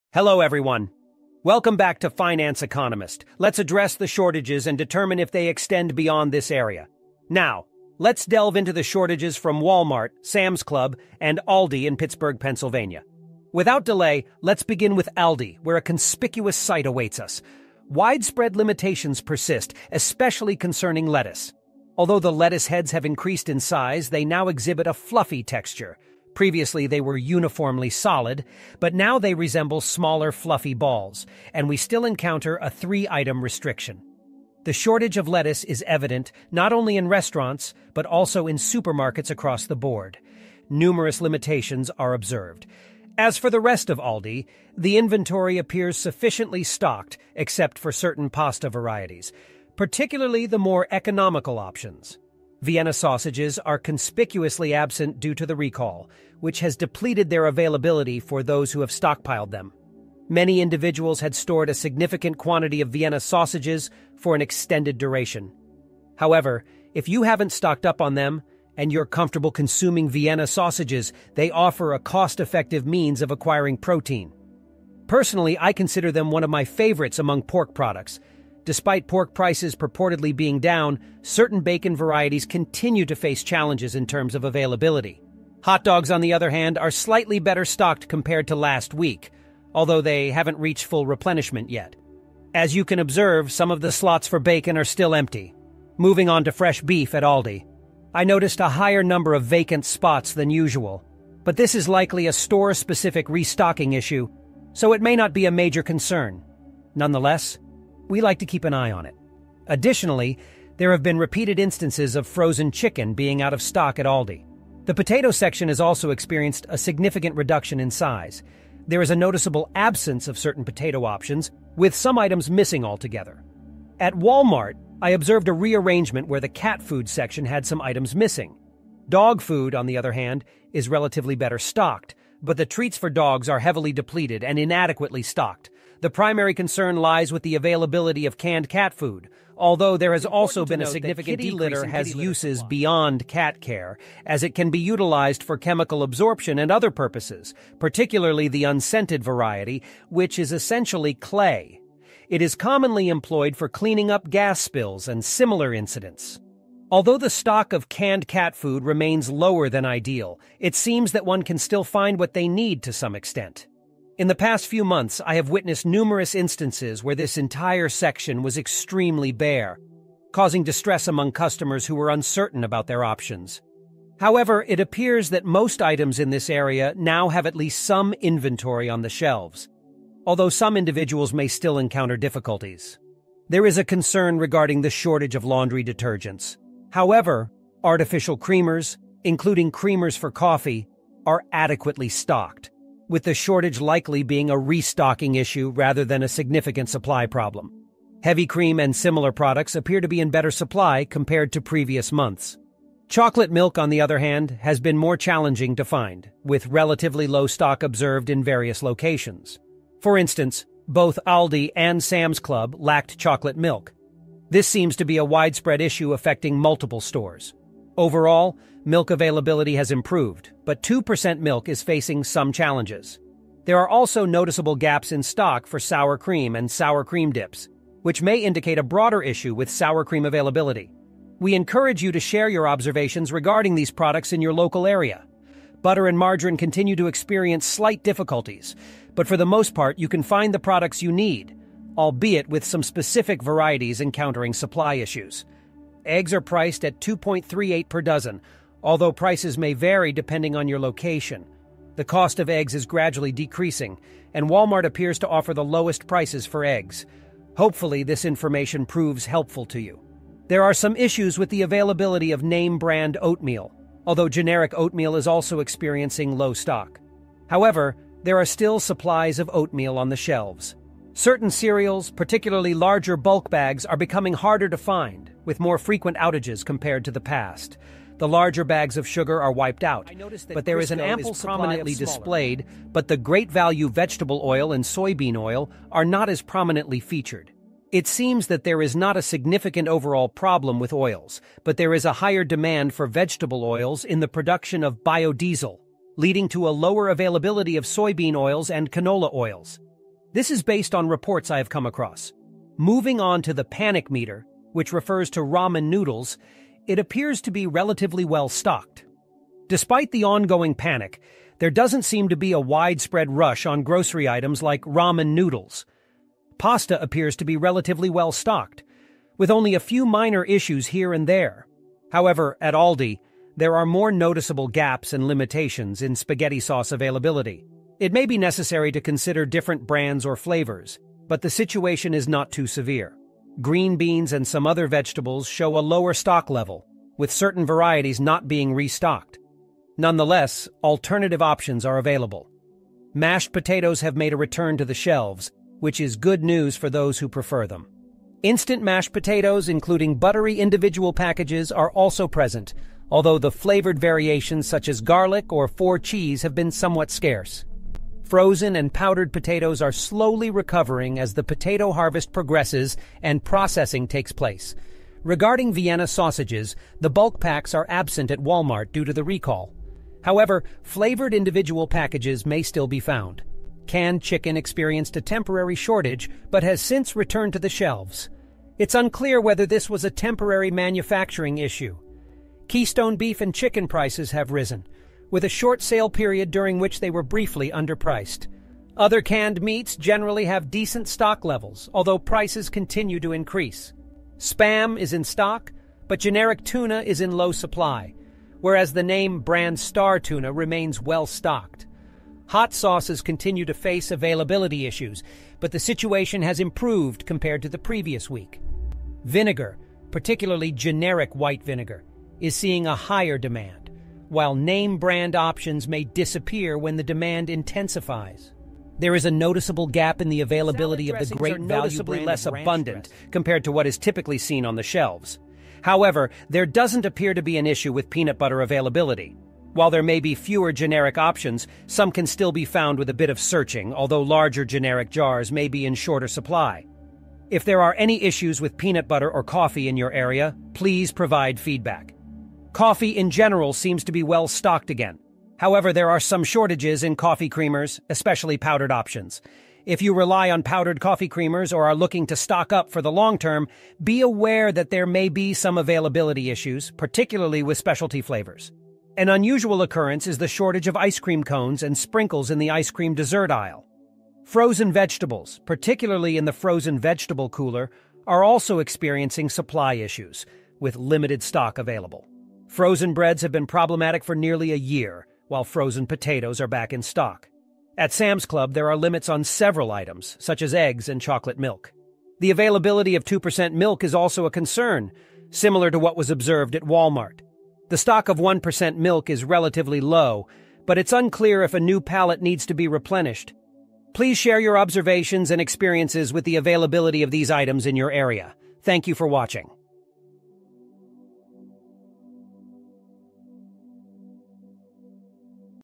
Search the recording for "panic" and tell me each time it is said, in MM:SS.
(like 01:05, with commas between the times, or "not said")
05:03, 05:10.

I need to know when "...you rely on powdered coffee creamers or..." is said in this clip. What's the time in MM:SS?
07:30.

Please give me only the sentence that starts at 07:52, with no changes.
Frozen breads have been problematic for nearly a year, while frozen potatoes are back in stock.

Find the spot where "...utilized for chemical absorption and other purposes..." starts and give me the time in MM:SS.
02:24.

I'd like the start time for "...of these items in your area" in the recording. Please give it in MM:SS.
08:17.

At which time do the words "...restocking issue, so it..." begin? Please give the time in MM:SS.
01:43.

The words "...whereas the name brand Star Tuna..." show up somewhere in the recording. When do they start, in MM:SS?
06:38.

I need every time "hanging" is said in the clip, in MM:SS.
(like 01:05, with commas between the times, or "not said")
not said.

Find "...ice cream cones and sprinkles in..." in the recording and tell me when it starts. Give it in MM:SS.
07:40.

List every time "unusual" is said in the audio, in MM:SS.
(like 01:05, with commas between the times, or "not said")
07:39.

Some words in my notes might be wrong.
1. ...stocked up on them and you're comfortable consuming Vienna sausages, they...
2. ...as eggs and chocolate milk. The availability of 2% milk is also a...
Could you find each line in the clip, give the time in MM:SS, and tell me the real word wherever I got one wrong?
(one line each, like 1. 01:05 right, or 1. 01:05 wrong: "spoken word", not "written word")
1. 01:07 right
2. 08:00 right.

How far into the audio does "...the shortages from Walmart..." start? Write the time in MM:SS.
00:08.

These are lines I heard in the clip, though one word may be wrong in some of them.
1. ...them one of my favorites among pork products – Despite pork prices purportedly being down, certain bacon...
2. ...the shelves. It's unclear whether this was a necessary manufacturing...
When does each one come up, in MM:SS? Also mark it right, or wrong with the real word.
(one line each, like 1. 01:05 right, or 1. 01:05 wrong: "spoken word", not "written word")
1. 01:16 right
2. 06:17 wrong: "temporary", not "necessary".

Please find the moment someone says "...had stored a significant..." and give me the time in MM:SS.
01:01.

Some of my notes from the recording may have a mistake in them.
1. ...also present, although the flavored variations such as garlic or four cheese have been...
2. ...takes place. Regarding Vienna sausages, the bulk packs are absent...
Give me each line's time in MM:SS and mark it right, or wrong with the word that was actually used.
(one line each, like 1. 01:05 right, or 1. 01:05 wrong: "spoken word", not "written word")
1. 05:51 right
2. 06:04 right.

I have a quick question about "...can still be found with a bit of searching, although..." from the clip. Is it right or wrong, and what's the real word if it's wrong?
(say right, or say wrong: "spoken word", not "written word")
right.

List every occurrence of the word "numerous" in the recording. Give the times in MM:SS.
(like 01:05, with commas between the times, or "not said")
00:40, 02:45.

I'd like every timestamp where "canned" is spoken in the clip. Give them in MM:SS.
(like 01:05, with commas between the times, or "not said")
02:18, 02:37, 06:13, 06:29.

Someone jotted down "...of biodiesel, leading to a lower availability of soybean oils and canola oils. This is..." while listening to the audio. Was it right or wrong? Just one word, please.
right.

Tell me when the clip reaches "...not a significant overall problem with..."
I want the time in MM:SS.
04:48.